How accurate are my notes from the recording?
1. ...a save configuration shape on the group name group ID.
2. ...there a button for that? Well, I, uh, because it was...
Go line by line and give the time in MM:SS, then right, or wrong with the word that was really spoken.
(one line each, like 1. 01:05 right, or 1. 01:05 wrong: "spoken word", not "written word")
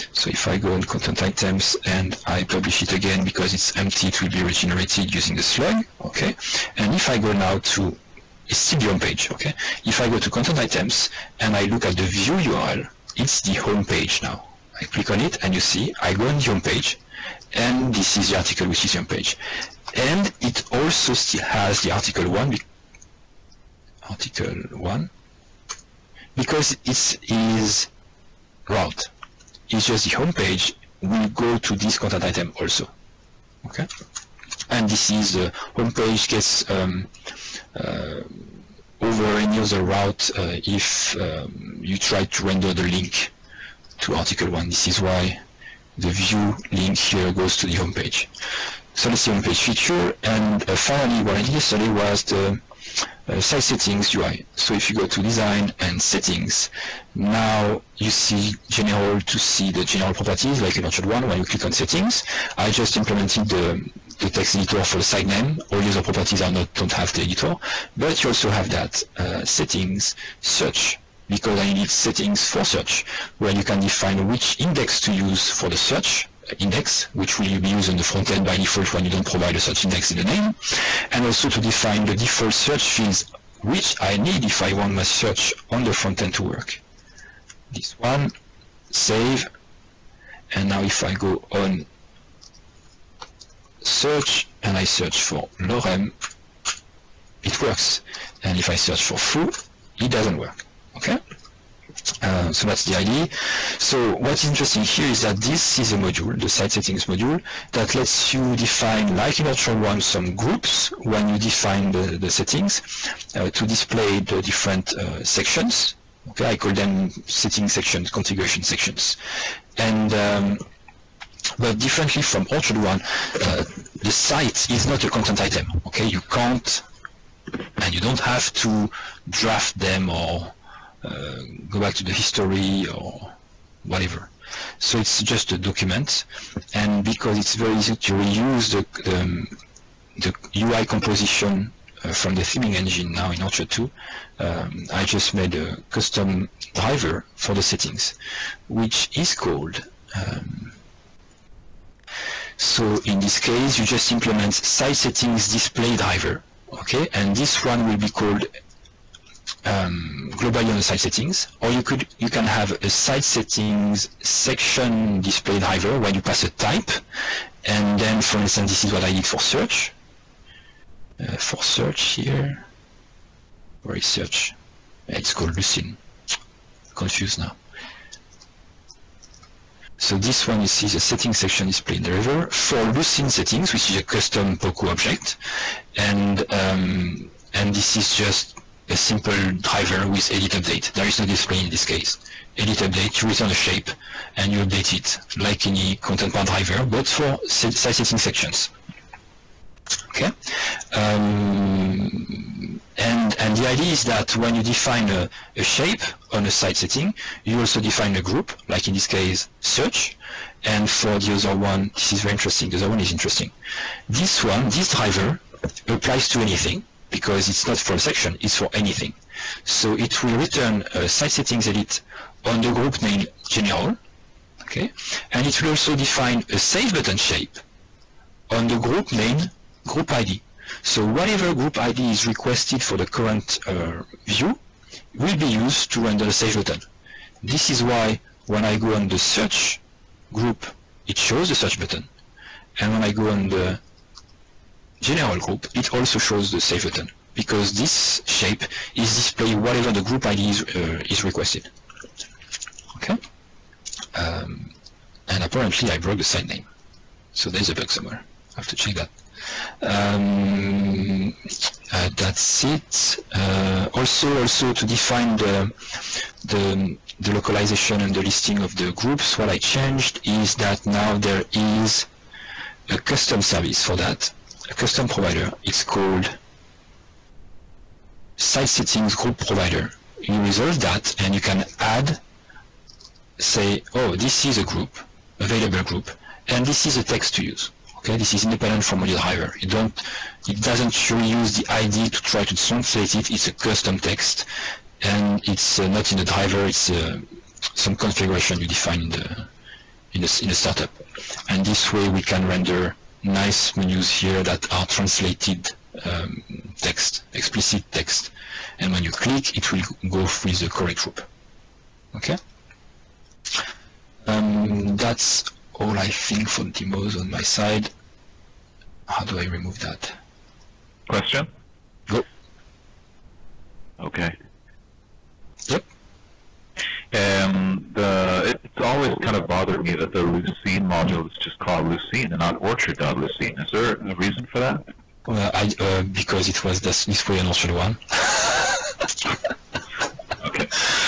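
1. 03:46 wrong: "button", not "configuration"
2. 05:33 wrong: "reason", not "button".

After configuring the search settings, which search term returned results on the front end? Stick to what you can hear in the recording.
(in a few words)
lorem.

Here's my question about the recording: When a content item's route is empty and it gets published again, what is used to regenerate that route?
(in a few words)
The slug.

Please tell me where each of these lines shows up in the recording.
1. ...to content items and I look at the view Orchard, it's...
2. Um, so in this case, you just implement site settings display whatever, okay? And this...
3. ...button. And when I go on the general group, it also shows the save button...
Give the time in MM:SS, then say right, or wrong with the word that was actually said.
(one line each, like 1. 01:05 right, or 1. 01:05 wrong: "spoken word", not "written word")
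1. 00:10 wrong: "URL", not "Orchard"
2. 02:30 wrong: "driver", not "whatever"
3. 04:01 right.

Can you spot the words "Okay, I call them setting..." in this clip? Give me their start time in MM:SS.
01:56.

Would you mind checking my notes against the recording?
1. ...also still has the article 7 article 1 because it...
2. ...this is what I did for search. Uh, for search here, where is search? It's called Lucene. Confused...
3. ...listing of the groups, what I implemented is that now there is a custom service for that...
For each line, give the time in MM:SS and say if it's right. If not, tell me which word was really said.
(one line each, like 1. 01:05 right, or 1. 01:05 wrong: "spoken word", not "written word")
1. 00:20 wrong: "1", not "7"
2. 02:48 right
3. 04:28 wrong: "changed", not "implemented".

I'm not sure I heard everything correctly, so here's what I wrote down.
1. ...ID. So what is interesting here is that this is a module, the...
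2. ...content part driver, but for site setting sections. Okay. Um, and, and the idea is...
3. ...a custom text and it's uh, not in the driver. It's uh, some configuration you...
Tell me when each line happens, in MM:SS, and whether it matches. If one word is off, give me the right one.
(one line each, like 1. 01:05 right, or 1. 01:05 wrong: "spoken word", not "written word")
1. 01:42 right
2. 03:15 right
3. 04:53 right.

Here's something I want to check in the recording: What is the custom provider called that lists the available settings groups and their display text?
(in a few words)
Site settings group provider.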